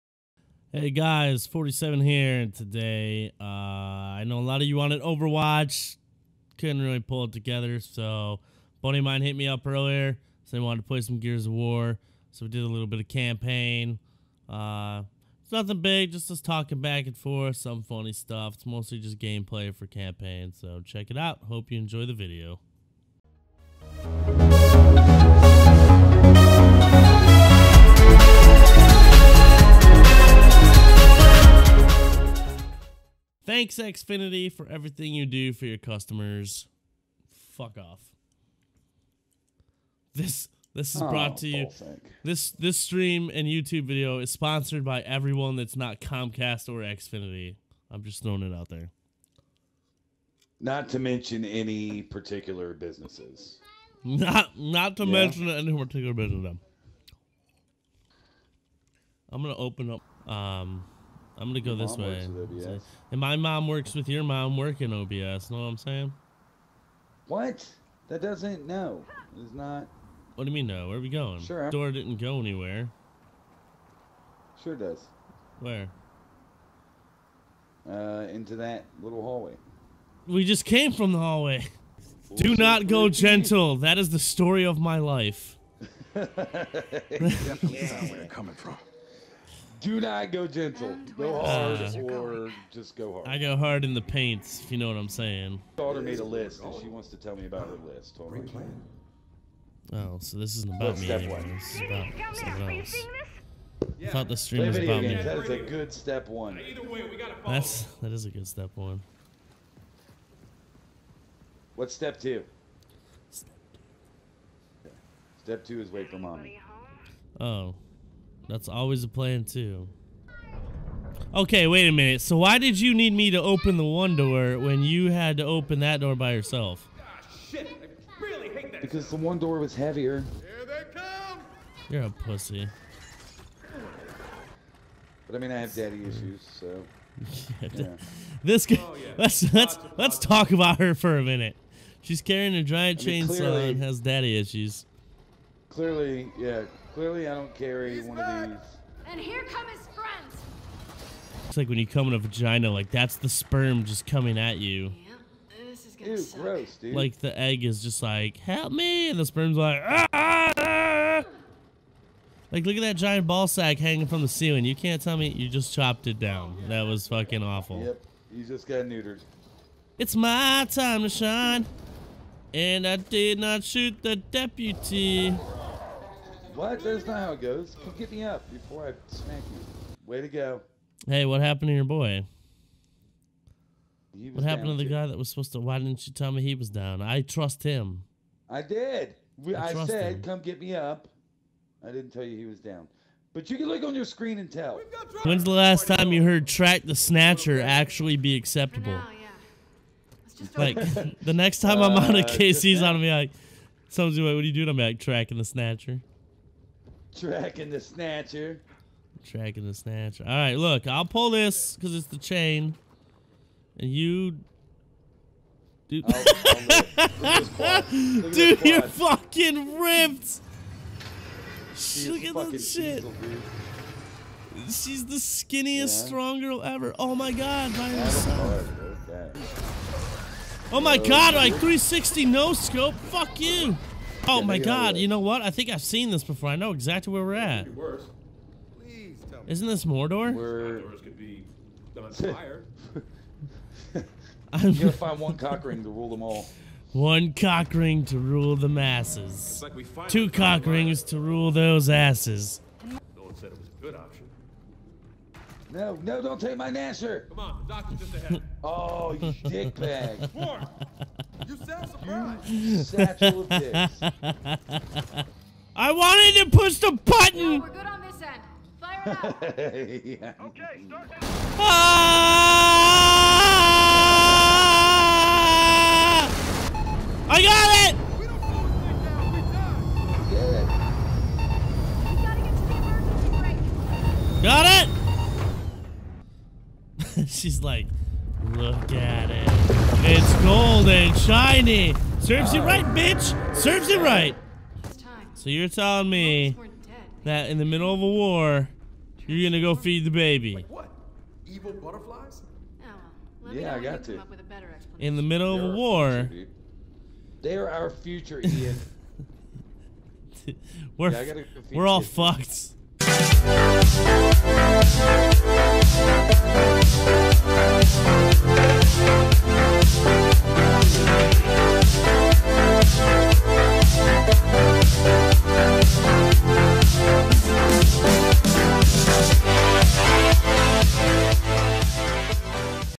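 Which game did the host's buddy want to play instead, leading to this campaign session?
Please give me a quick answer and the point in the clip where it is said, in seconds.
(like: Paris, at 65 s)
Gears of War, at 11 s.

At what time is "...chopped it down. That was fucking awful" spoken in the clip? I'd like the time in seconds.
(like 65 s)
165 s.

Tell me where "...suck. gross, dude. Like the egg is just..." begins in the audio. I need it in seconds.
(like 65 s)
156 s.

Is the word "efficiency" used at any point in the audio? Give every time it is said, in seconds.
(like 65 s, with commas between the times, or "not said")
not said.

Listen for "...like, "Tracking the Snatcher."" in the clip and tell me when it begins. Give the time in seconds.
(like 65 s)
204 s.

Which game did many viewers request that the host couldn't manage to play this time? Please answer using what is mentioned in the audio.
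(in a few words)
Overwatch.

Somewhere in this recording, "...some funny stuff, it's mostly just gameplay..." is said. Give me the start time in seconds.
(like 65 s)
17 s.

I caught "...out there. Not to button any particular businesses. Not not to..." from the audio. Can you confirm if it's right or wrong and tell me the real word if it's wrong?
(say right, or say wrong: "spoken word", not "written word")
wrong: "mention", not "button".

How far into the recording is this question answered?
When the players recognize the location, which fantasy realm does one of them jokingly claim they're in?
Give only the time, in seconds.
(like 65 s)
239 s.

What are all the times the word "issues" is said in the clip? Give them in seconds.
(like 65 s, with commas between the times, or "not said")
136 s, 144 s.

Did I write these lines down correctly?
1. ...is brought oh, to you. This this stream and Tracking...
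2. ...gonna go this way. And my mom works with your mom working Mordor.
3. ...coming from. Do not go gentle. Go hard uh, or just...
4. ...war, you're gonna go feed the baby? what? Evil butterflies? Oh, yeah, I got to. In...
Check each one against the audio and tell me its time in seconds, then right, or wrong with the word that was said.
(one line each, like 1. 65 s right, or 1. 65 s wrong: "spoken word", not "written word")
1. 40 s wrong: "YouTube", not "Tracking"
2. 61 s wrong: "OBS", not "Mordor"
3. 88 s right
4. 298 s right.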